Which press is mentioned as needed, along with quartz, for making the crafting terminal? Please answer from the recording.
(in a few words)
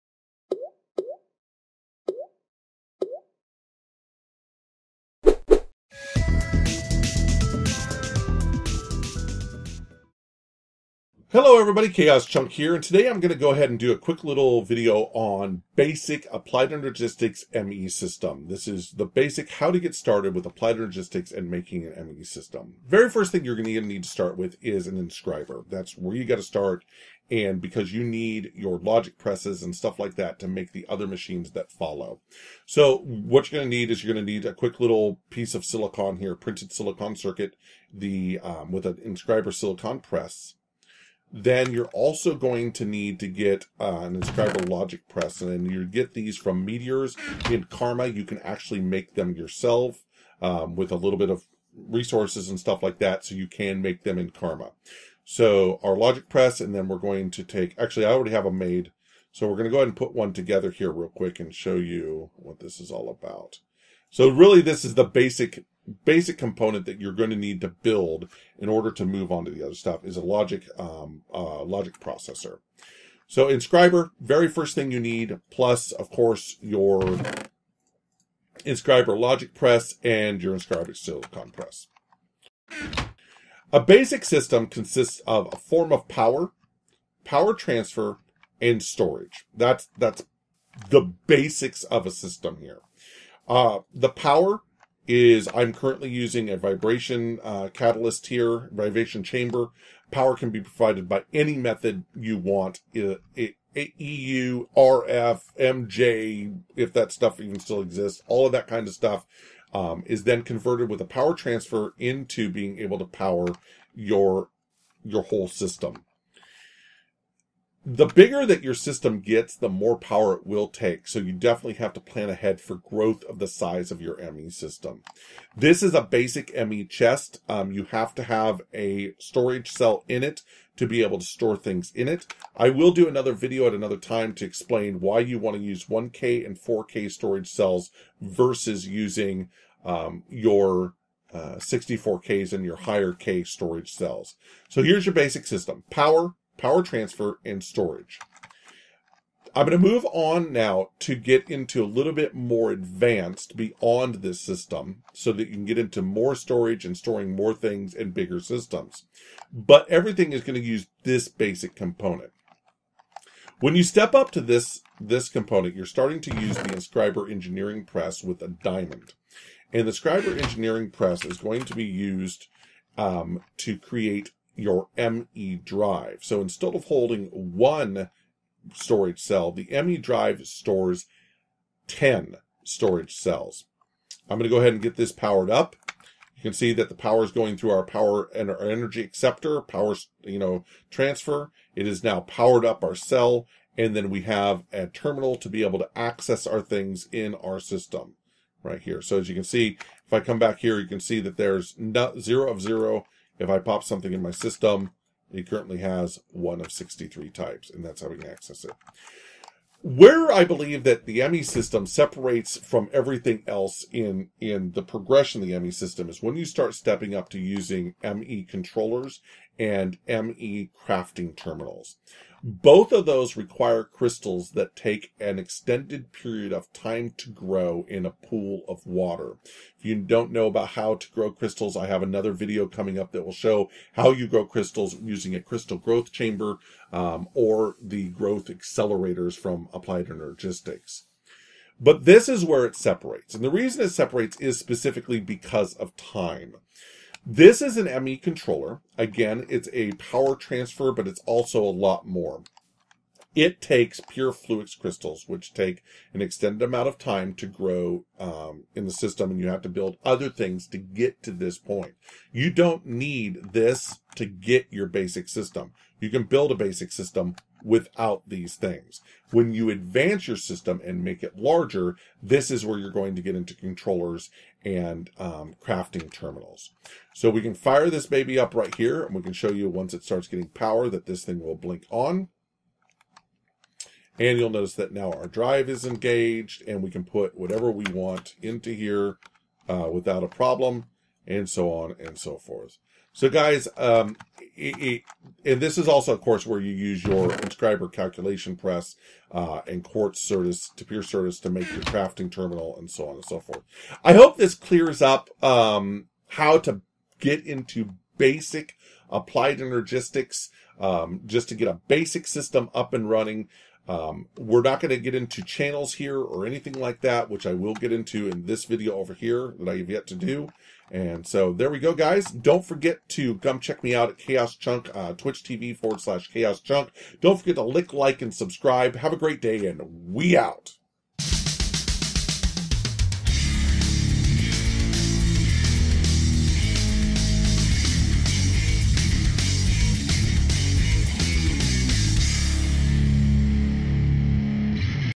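inscriber calculation press.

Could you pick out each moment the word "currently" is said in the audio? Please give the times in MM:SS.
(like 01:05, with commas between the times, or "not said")
01:35, 03:25.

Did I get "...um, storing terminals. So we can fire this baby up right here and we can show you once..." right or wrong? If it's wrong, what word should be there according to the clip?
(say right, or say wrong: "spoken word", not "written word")
wrong: "crafting", not "storing".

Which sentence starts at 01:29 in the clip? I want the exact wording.
That's that's the basics of a system here.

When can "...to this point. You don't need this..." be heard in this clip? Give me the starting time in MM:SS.
04:21.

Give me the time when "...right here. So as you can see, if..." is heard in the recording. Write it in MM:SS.
03:18.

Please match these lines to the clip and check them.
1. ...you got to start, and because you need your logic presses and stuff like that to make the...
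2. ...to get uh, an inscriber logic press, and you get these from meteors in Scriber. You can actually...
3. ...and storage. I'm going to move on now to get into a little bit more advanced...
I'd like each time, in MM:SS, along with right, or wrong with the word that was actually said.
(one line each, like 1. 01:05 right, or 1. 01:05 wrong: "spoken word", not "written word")
1. 00:26 right
2. 00:43 wrong: "Karma", not "Scriber"
3. 02:27 right.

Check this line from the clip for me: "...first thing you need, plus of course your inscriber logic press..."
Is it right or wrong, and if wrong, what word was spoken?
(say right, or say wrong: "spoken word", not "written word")
right.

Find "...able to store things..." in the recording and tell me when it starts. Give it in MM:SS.
02:11.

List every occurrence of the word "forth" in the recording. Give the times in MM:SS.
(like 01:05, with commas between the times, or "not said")
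04:52, 05:03.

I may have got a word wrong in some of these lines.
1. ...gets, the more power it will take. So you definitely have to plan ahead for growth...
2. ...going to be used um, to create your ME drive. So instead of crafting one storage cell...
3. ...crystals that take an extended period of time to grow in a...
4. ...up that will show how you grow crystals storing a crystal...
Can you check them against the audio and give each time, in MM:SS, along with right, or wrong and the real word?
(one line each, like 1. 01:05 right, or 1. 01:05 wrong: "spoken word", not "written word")
1. 01:59 right
2. 02:51 wrong: "holding", not "crafting"
3. 03:43 right
4. 03:52 wrong: "using", not "storing".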